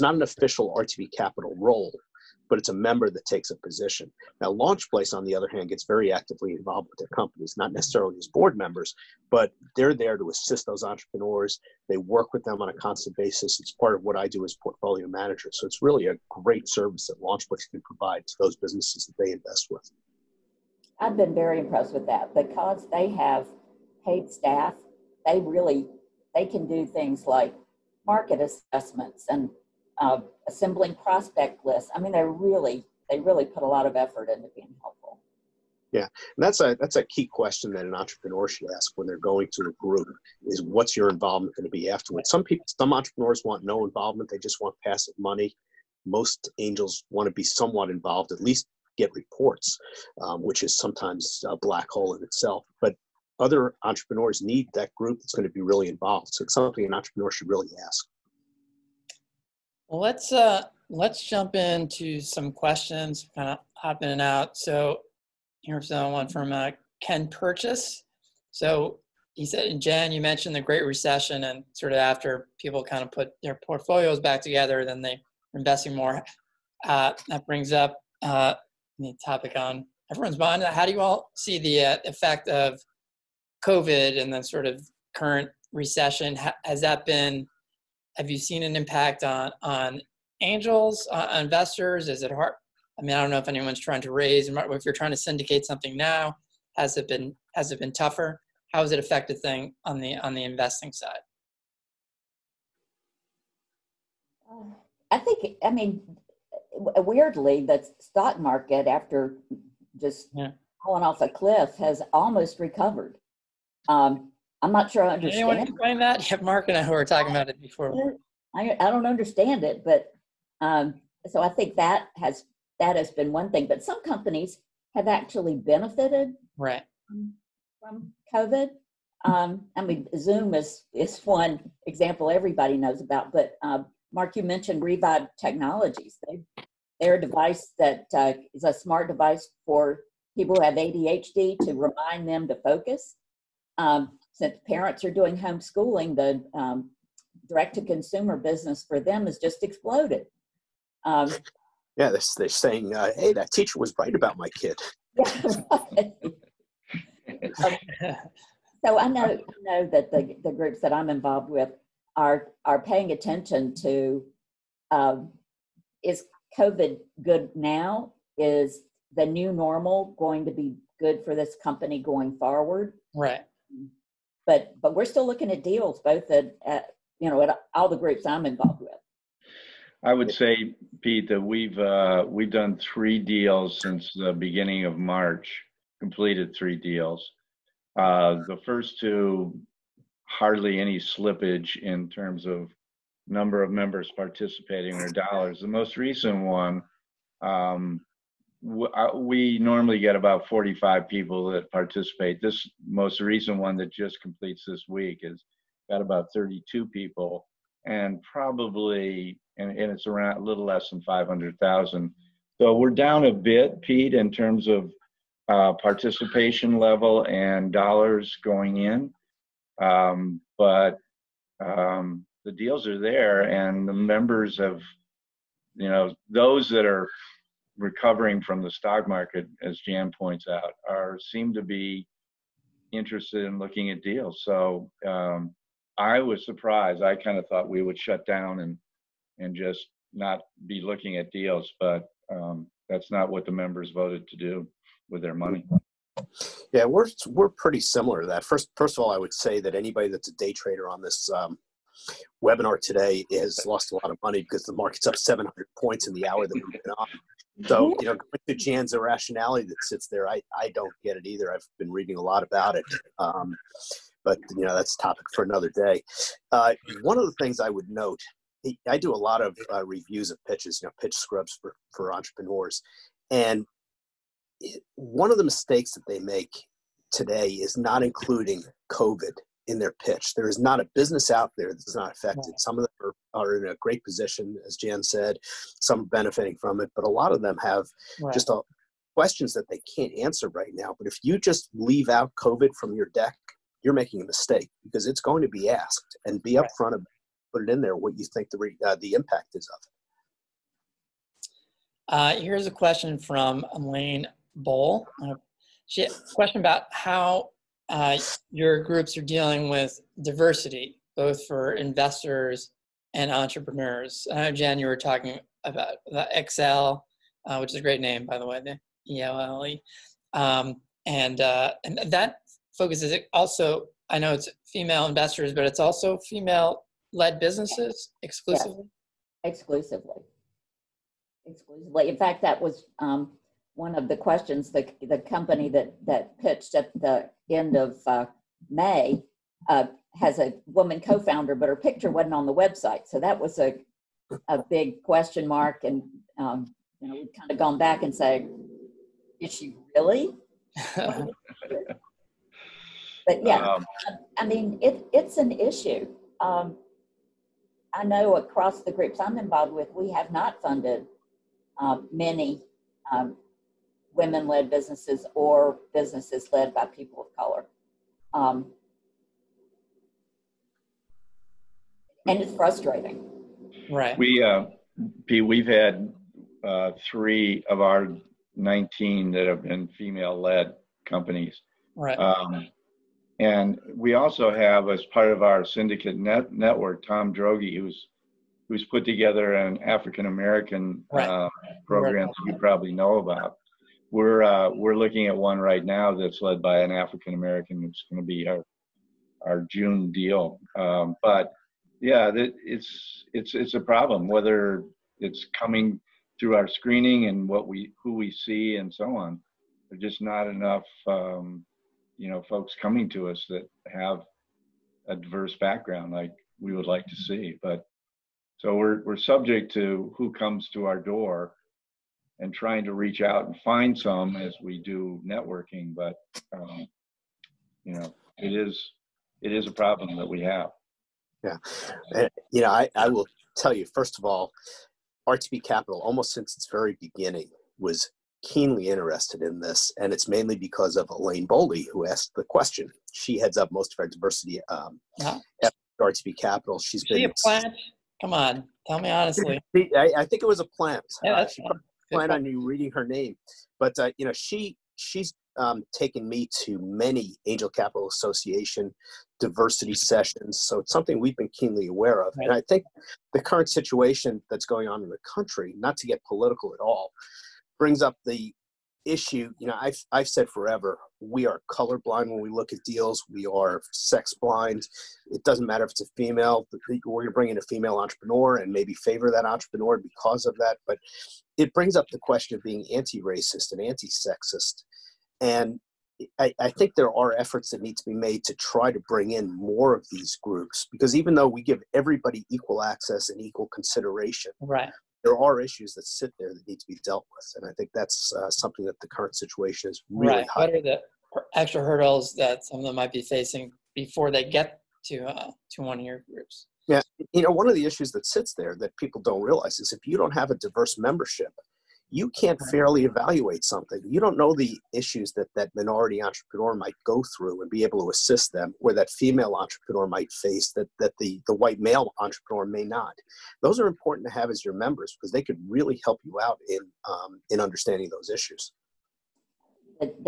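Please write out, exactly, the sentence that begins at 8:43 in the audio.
Those are important to have as your members because they could really help you out in um, in understanding those issues.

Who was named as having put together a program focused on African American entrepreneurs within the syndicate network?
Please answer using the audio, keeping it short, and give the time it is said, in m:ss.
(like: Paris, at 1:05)
Tom Drogi, at 6:27.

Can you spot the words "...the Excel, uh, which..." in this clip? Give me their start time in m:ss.
5:16.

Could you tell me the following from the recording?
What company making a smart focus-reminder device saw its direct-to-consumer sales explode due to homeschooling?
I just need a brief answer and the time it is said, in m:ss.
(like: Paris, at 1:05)
Revive Technologies, at 2:14.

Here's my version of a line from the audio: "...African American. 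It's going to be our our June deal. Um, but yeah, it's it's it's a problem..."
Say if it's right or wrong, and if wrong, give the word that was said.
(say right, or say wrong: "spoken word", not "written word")
right.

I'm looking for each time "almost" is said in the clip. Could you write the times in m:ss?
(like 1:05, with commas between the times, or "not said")
1:52, 7:16.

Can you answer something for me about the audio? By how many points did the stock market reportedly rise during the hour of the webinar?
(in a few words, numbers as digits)
700.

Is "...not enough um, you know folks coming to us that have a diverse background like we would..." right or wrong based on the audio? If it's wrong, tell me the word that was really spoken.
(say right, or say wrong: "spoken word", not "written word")
right.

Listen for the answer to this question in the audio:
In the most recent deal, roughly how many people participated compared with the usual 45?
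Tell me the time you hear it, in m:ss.
3:26.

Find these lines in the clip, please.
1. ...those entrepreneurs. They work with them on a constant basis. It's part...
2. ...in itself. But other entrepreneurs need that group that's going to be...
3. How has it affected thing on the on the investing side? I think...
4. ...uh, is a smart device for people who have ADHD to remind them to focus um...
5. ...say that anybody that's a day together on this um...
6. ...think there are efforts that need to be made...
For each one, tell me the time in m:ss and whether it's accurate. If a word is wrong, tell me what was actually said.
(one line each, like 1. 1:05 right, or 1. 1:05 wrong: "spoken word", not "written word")
1. 0:10 right
2. 0:52 right
3. 1:38 right
4. 2:18 right
5. 4:09 wrong: "trader", not "together"
6. 8:06 right.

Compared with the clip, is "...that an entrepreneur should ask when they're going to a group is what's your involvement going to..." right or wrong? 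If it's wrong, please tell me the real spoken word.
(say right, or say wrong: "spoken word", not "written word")
right.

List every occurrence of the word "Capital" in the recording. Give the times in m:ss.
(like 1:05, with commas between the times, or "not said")
0:01, 7:15, 7:26, 7:37.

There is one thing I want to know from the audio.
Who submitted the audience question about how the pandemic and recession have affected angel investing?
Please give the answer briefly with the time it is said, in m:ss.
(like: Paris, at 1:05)
Ken Purchase, at 1:07.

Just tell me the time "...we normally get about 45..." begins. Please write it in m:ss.
3:19.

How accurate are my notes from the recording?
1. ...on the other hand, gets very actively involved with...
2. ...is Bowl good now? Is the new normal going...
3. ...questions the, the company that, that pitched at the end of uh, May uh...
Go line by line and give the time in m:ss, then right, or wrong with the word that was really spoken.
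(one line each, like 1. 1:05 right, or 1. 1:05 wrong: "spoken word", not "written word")
1. 0:05 right
2. 2:46 wrong: "COVID", not "Bowl"
3. 5:34 right.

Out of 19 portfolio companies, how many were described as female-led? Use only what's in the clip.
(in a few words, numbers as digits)
3.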